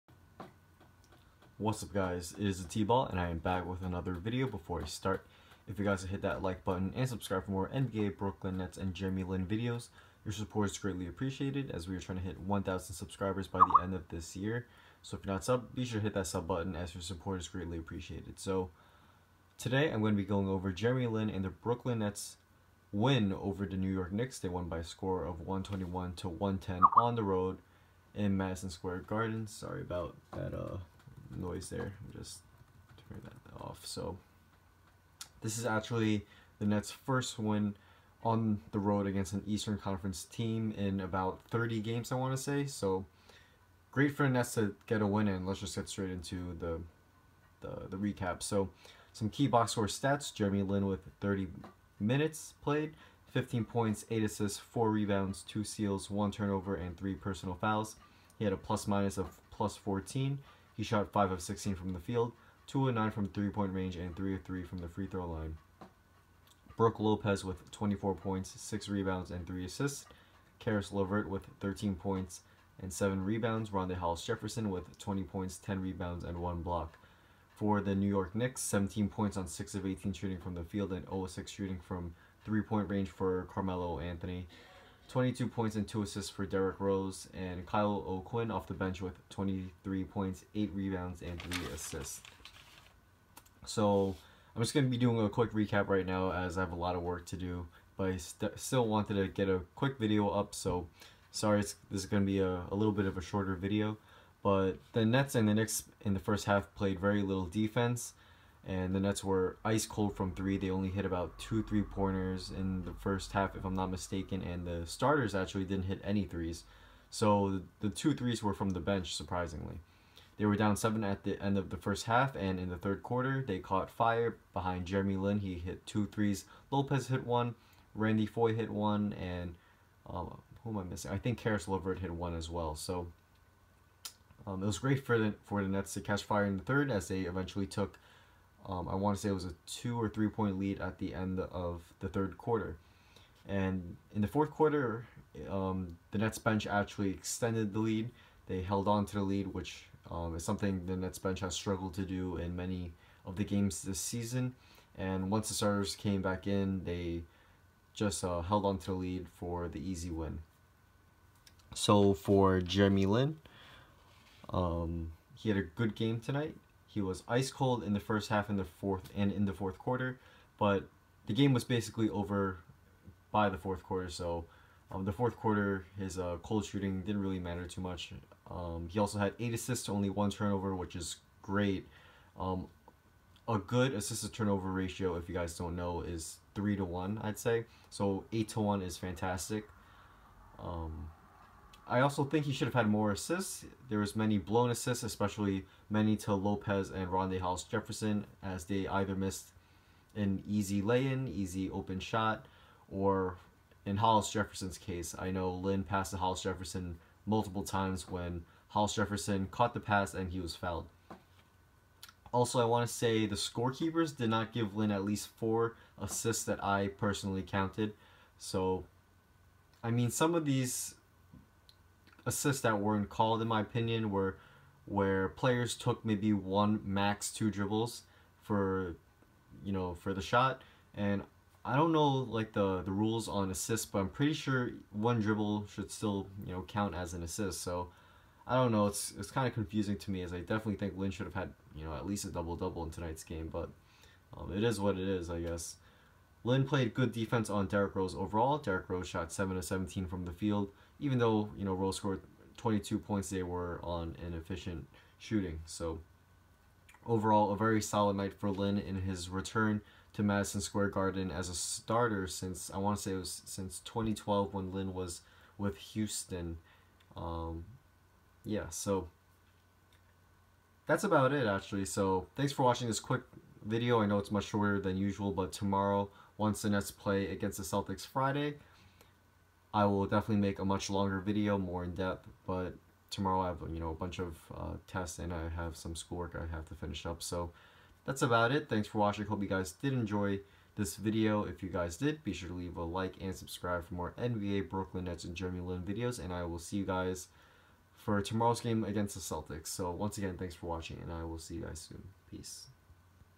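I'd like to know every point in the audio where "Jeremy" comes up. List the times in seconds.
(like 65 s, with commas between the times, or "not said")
8 s, 20 s, 50 s, 124 s, 162 s, 295 s.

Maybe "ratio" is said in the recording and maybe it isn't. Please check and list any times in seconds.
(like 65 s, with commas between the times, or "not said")
184 s.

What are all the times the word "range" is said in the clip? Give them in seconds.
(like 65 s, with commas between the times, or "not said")
63 s, 82 s.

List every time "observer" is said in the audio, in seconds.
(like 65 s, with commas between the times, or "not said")
not said.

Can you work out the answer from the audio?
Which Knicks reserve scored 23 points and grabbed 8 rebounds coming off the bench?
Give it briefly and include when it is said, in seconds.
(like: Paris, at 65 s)
Kyle O'Quinn, at 87 s.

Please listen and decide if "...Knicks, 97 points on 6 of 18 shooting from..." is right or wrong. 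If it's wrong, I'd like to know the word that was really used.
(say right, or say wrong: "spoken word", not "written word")
wrong: "17", not "97".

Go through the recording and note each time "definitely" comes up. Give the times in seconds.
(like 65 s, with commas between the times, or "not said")
240 s, 280 s.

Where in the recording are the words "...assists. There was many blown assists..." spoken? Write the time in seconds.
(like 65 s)
193 s.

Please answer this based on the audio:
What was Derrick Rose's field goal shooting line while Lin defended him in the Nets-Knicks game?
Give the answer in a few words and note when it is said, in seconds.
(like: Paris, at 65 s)
7 of 17, at 249 s.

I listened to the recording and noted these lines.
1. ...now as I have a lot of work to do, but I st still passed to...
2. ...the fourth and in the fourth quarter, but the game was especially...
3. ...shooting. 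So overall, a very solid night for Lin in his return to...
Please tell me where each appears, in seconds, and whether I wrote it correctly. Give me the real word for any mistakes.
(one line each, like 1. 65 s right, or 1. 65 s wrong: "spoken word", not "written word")
1. 96 s wrong: "wanted", not "passed"
2. 168 s wrong: "basically", not "especially"
3. 255 s right.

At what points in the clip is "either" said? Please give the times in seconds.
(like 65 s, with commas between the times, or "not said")
198 s.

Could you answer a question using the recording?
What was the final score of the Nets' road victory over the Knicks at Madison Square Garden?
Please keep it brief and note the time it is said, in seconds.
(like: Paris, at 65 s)
121 to 110, at 25 s.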